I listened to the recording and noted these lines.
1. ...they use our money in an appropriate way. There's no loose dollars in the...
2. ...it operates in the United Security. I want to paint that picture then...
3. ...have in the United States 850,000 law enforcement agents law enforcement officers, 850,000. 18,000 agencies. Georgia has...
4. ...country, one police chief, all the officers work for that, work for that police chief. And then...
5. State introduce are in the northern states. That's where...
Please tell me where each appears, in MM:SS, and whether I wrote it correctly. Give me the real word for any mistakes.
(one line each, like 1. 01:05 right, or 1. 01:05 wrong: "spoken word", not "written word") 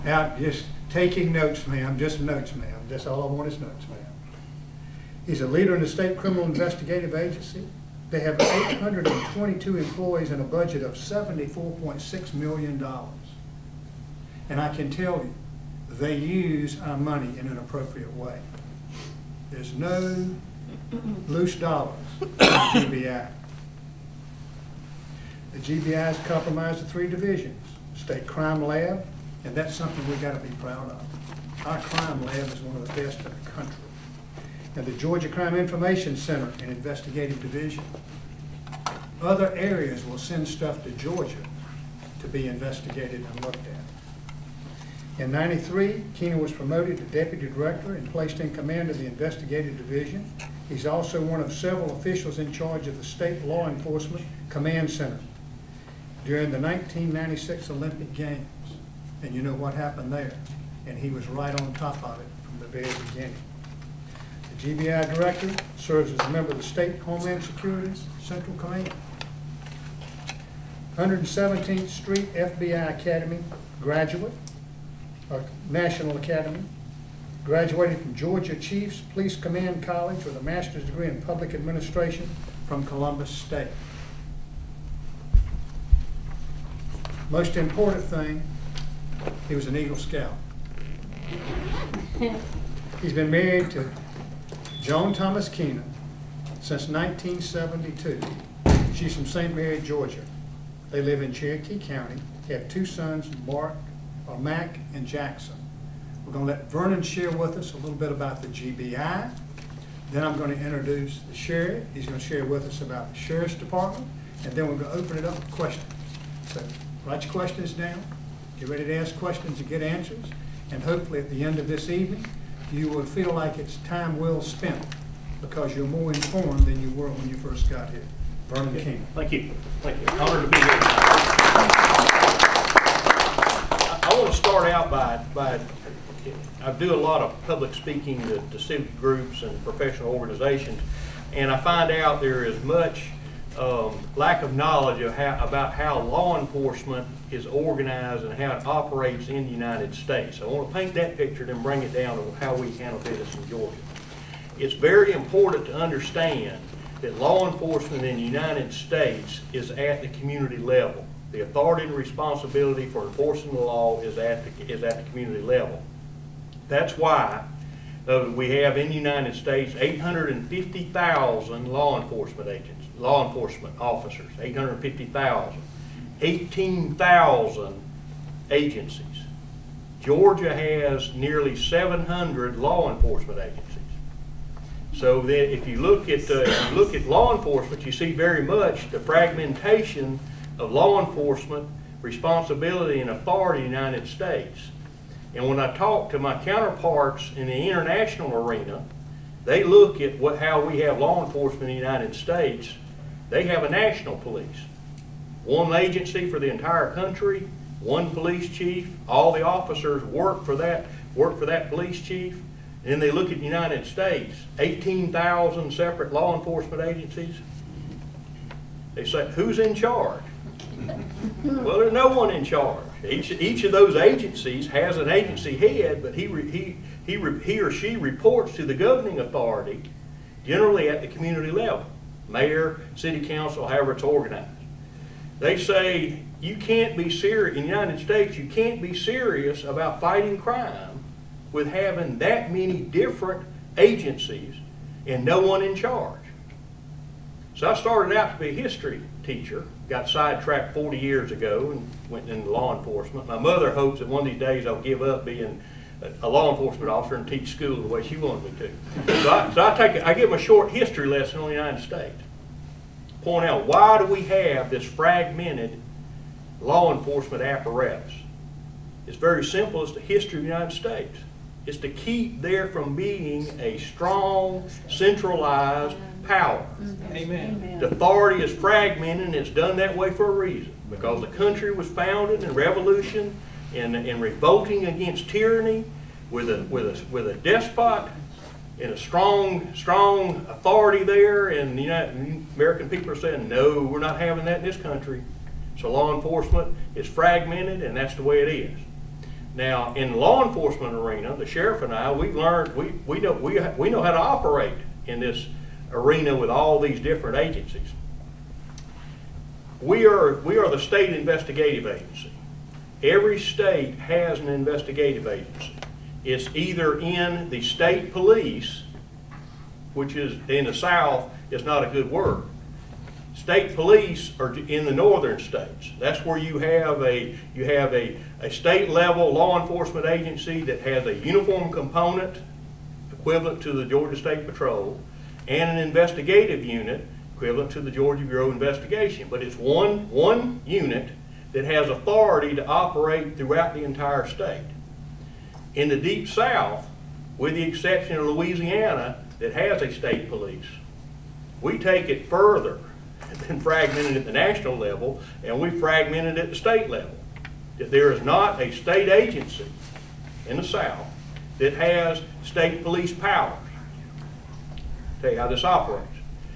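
1. 00:15 right
2. 02:28 wrong: "States", not "Security"
3. 02:48 right
4. 03:26 right
5. 05:23 wrong: "police", not "introduce".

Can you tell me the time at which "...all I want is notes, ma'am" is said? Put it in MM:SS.
00:03.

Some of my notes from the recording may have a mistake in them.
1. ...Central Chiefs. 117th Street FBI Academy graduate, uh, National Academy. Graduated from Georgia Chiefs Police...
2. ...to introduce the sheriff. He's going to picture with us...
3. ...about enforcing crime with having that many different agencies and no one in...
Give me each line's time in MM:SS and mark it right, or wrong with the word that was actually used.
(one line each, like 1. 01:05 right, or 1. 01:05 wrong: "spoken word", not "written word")
1. 01:08 wrong: "Command", not "Chiefs"
2. 01:50 wrong: "share", not "picture"
3. 03:59 wrong: "fighting", not "enforcing".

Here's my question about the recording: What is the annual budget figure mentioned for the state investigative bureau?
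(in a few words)
$74.6 million.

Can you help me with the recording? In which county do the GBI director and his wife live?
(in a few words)
Cherokee County.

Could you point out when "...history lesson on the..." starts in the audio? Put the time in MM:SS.
04:20.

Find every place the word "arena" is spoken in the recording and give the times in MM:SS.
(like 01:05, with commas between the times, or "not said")
03:18, 05:00, 05:05.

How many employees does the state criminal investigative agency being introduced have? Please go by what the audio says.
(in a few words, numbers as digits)
822.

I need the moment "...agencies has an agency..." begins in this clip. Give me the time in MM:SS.
03:43.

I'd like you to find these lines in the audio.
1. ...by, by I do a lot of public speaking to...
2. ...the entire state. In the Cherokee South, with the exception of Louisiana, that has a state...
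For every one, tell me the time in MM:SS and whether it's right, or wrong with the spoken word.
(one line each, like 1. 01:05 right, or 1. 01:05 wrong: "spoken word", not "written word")
1. 02:14 right
2. 05:43 wrong: "Deep", not "Cherokee".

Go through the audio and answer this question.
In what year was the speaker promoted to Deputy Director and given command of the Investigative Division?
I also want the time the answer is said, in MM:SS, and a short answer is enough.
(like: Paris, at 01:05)
1993, at 00:45.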